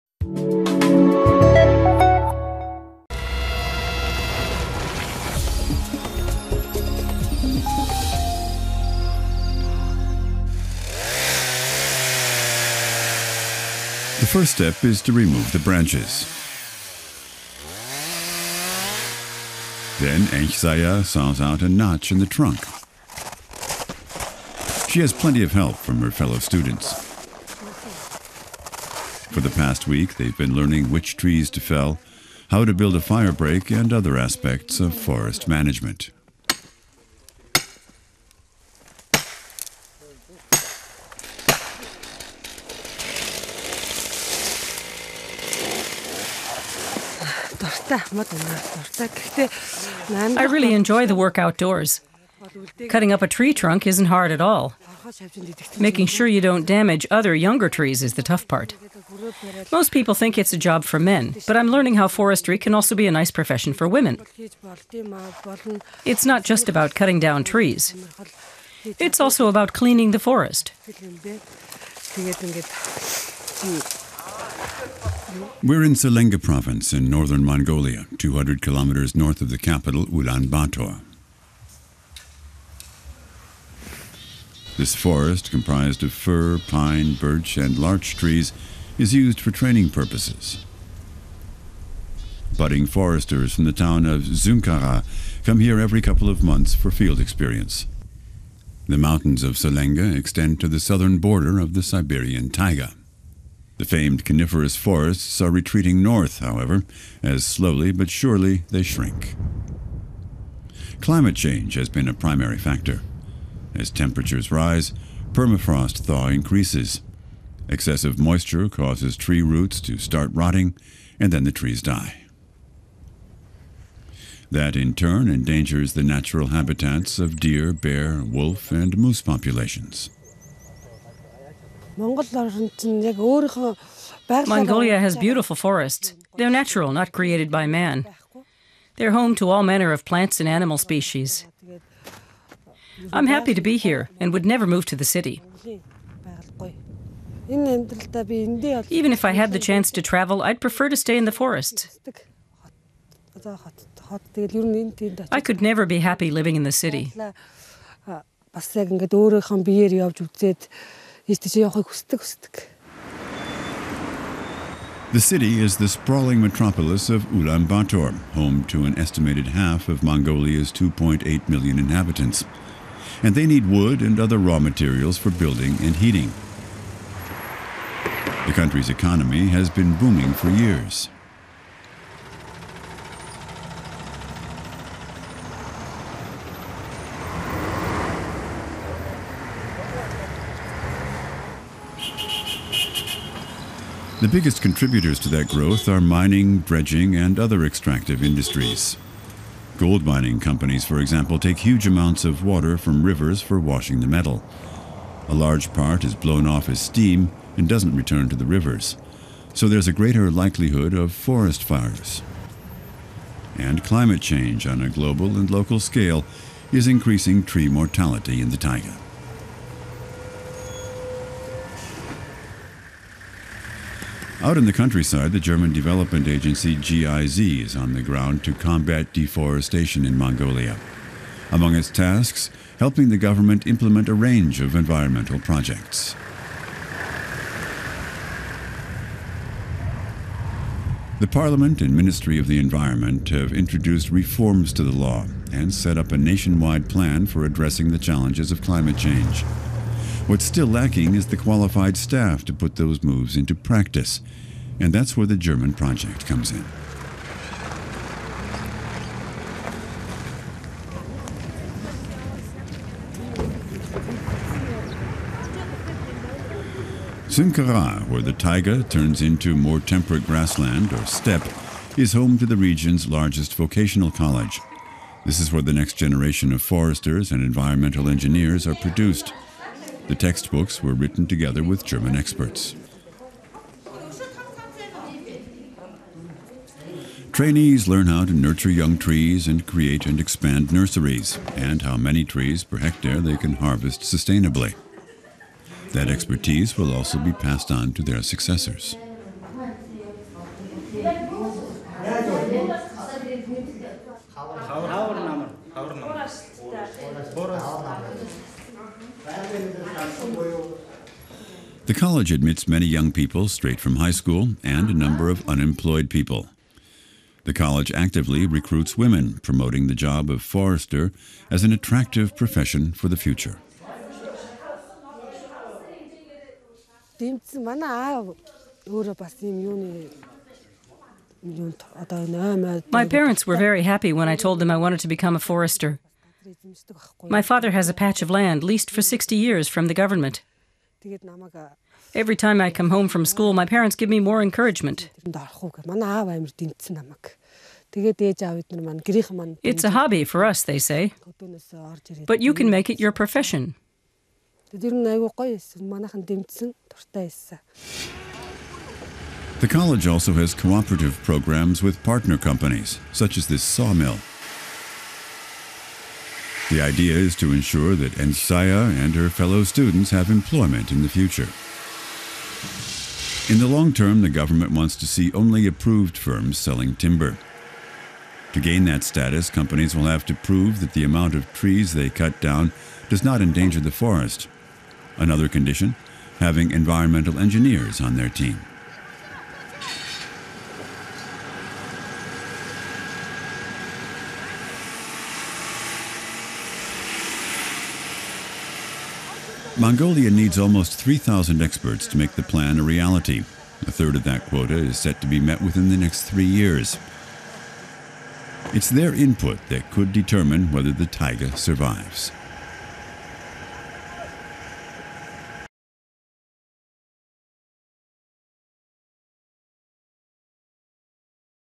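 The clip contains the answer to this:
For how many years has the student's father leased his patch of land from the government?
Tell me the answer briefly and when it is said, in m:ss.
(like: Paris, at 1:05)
60 years, at 5:39.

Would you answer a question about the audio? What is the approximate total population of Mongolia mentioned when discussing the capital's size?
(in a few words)
2.8 million.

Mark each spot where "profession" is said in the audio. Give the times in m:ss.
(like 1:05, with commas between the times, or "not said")
1:03, 5:22, 5:53.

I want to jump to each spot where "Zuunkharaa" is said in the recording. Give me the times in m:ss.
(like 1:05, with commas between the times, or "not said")
1:34, 4:27.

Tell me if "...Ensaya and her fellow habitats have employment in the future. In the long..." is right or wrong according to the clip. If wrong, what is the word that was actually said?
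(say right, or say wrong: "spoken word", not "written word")
wrong: "students", not "habitats".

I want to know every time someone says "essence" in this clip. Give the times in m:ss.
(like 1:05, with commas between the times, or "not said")
not said.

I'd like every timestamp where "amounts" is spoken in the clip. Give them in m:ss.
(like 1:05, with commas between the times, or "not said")
3:21, 6:21.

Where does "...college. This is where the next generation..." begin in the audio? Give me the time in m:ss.
4:34.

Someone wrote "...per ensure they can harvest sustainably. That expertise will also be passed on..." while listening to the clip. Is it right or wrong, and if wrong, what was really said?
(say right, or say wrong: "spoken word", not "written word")
wrong: "hectare", not "ensure".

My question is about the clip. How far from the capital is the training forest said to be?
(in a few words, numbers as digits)
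200 kilometers.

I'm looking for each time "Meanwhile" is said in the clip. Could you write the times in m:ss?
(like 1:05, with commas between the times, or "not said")
not said.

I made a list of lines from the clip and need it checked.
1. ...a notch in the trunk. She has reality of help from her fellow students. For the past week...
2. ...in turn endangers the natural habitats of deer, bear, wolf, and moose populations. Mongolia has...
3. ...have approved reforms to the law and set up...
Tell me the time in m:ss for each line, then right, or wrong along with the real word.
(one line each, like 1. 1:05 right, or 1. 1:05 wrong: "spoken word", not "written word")
1. 0:21 wrong: "plenty", not "reality"
2. 2:04 right
3. 4:03 wrong: "introduced", not "approved".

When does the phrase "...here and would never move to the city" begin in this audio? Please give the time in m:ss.
2:23.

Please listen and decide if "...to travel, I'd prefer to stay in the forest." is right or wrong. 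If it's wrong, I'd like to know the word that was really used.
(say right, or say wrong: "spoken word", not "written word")
right.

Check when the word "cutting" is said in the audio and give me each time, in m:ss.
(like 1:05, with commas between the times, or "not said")
0:52, 1:06.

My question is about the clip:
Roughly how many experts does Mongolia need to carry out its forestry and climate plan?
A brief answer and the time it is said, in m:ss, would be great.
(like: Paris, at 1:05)
3,000, at 6:40.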